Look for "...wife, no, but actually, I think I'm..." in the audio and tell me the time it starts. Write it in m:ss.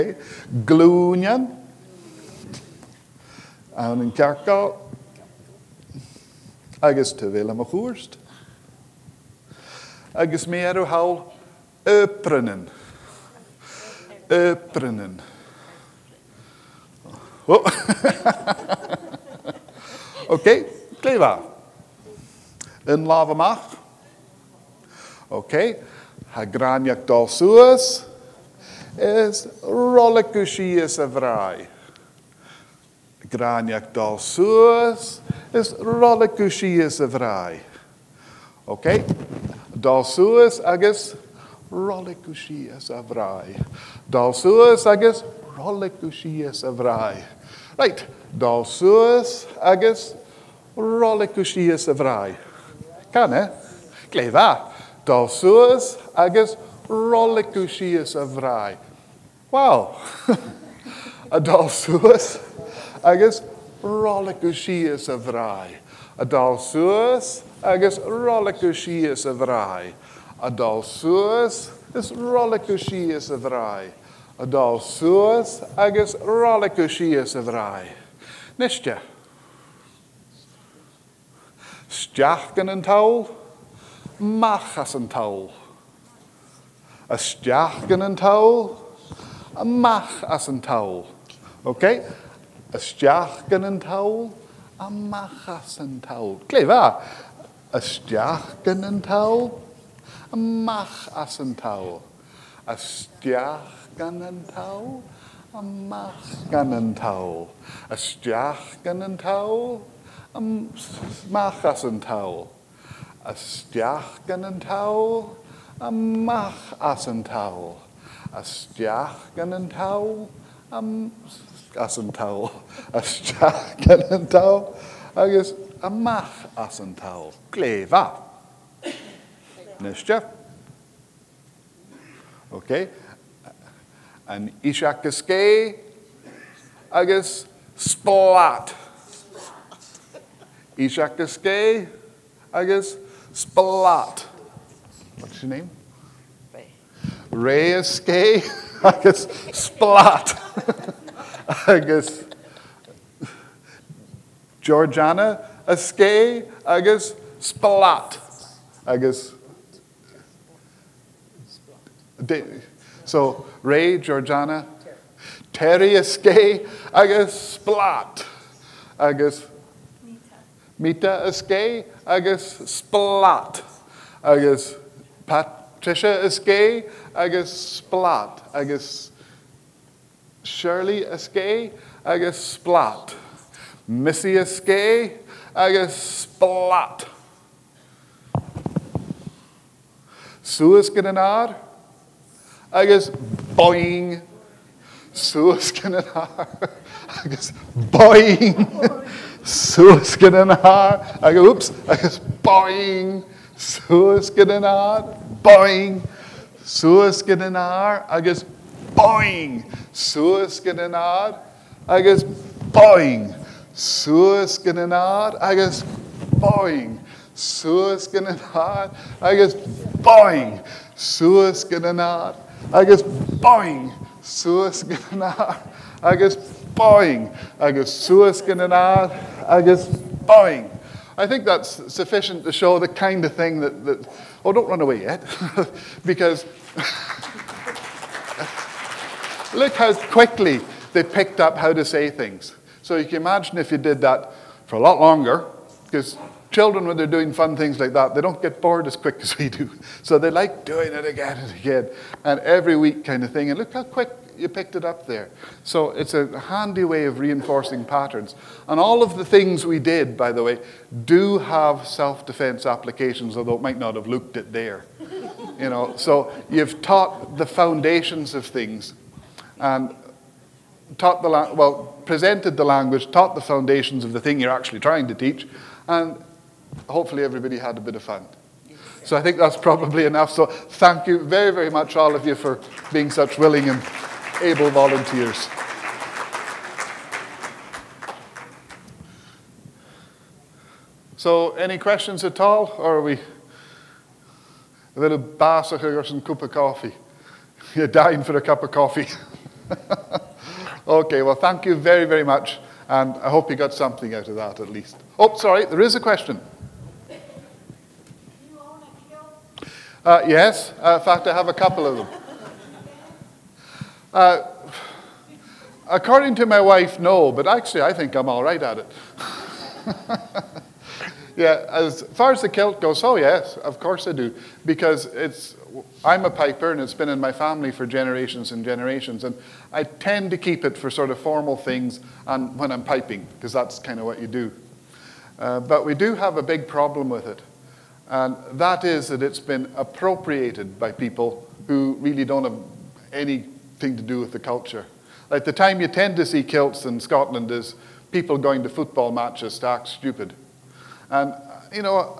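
5:16.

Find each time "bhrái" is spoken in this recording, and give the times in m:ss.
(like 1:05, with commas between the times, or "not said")
1:05, 1:09, 1:13, 1:17.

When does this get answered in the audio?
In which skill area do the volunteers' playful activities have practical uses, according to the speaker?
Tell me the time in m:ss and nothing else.
4:21.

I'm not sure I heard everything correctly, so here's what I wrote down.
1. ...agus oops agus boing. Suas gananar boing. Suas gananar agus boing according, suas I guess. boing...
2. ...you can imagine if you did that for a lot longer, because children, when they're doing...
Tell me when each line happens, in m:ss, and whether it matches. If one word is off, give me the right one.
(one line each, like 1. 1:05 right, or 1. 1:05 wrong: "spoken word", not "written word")
1. 3:21 wrong: "boing", not "according"
2. 4:02 right.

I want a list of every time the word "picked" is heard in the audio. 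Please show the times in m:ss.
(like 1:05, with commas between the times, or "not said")
4:01, 4:14.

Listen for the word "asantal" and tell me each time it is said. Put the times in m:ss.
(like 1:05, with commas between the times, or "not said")
2:01, 2:06.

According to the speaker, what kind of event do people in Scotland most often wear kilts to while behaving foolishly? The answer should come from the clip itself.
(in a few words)
football matches.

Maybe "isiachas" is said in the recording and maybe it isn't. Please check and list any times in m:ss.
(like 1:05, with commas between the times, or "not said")
2:14, 2:20.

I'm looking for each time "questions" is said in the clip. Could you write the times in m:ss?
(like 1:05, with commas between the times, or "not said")
4:51, 5:06.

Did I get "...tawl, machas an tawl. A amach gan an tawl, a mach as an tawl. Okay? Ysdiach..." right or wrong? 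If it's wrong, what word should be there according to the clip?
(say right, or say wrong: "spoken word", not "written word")
wrong: "stiach", not "amach".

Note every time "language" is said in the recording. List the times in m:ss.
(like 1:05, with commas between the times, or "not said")
4:32.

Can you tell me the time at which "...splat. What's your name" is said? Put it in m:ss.
2:23.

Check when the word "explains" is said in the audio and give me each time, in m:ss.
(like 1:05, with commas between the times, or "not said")
not said.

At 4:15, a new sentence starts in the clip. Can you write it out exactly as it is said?
So it's a handy way of reinforcing patterns.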